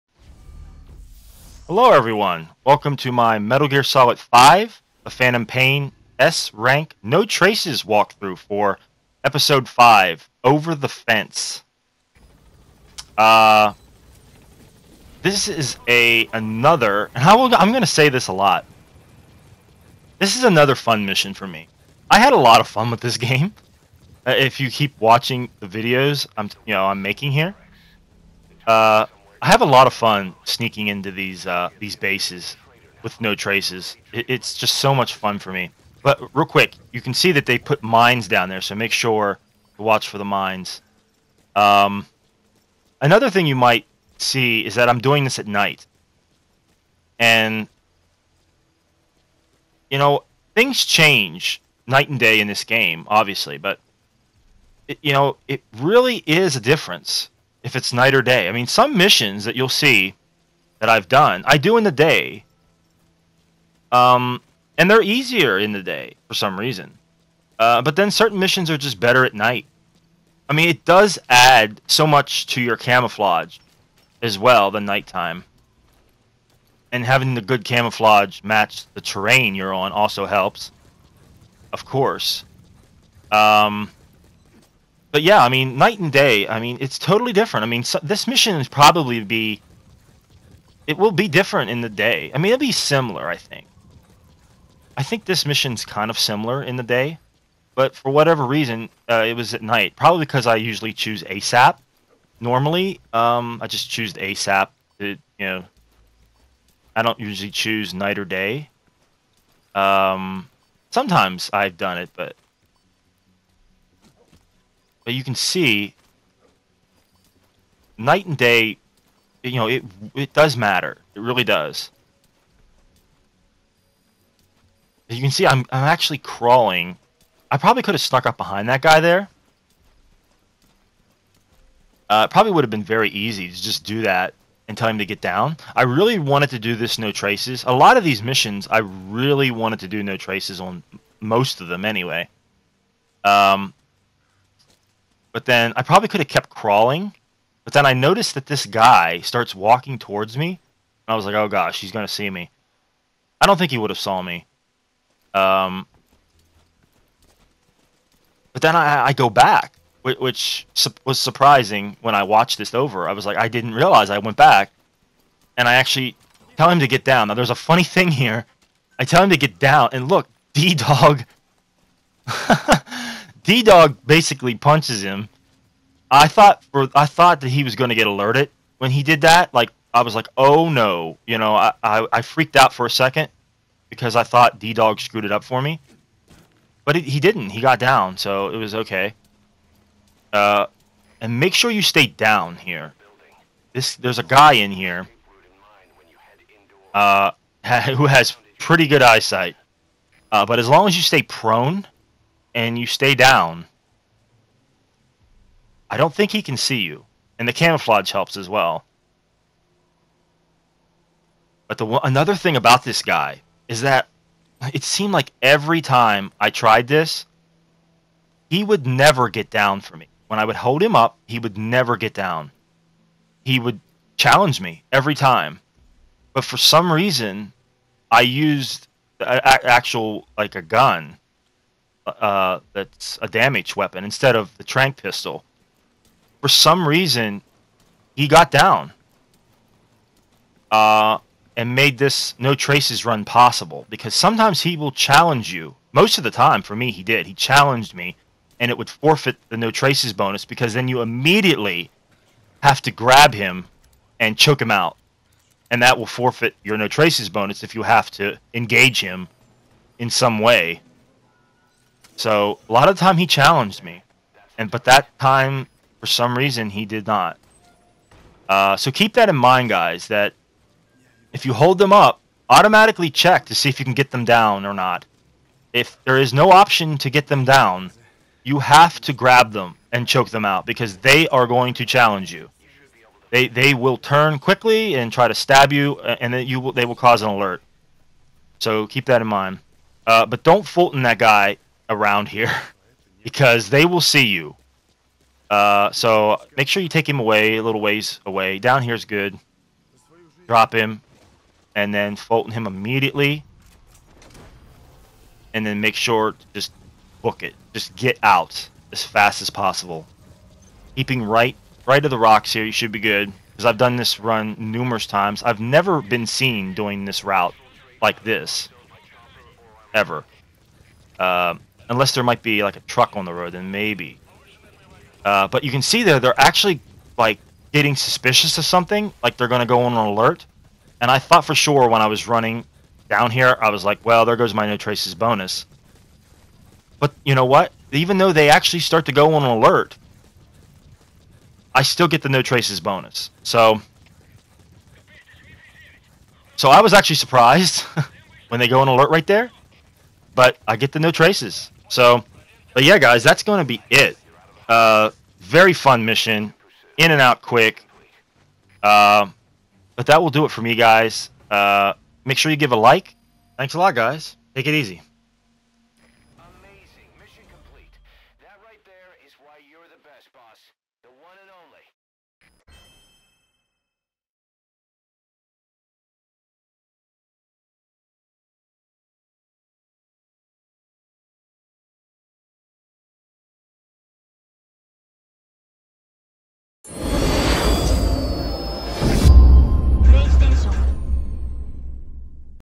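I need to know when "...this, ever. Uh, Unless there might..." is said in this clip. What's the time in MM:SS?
05:18.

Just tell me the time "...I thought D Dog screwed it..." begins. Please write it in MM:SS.
03:04.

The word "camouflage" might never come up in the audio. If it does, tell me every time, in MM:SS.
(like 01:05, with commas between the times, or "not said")
01:12, 01:17, 03:27.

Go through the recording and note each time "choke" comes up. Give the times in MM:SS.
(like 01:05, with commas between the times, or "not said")
04:14, 04:40.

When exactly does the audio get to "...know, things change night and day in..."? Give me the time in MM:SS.
00:49.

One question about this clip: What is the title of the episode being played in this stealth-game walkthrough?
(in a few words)
Over the Fence.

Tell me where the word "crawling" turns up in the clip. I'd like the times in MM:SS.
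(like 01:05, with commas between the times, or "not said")
02:06, 02:26.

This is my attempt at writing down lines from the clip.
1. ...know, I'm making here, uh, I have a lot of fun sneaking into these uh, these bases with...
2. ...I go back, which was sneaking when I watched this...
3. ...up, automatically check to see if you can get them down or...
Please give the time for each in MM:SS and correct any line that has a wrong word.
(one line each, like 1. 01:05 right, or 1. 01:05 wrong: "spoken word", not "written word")
1. 00:26 right
2. 02:39 wrong: "surprising", not "sneaking"
3. 04:31 right.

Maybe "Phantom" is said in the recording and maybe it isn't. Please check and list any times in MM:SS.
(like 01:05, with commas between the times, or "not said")
00:05.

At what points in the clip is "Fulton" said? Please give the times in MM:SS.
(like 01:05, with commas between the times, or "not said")
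04:50, 05:02.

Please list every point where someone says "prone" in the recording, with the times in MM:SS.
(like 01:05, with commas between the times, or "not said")
03:21.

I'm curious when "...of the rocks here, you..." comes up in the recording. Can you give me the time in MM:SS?
05:12.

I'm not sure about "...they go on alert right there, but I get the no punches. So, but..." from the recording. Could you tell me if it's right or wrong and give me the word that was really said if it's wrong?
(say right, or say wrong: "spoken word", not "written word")
wrong: "traces", not "punches".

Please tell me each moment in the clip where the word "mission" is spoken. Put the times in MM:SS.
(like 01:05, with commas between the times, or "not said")
00:21, 00:58, 01:08, 01:28, 01:35, 02:18, 05:56.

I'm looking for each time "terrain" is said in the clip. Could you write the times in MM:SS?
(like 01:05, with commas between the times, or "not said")
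01:19.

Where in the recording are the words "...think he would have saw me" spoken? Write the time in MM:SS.
02:33.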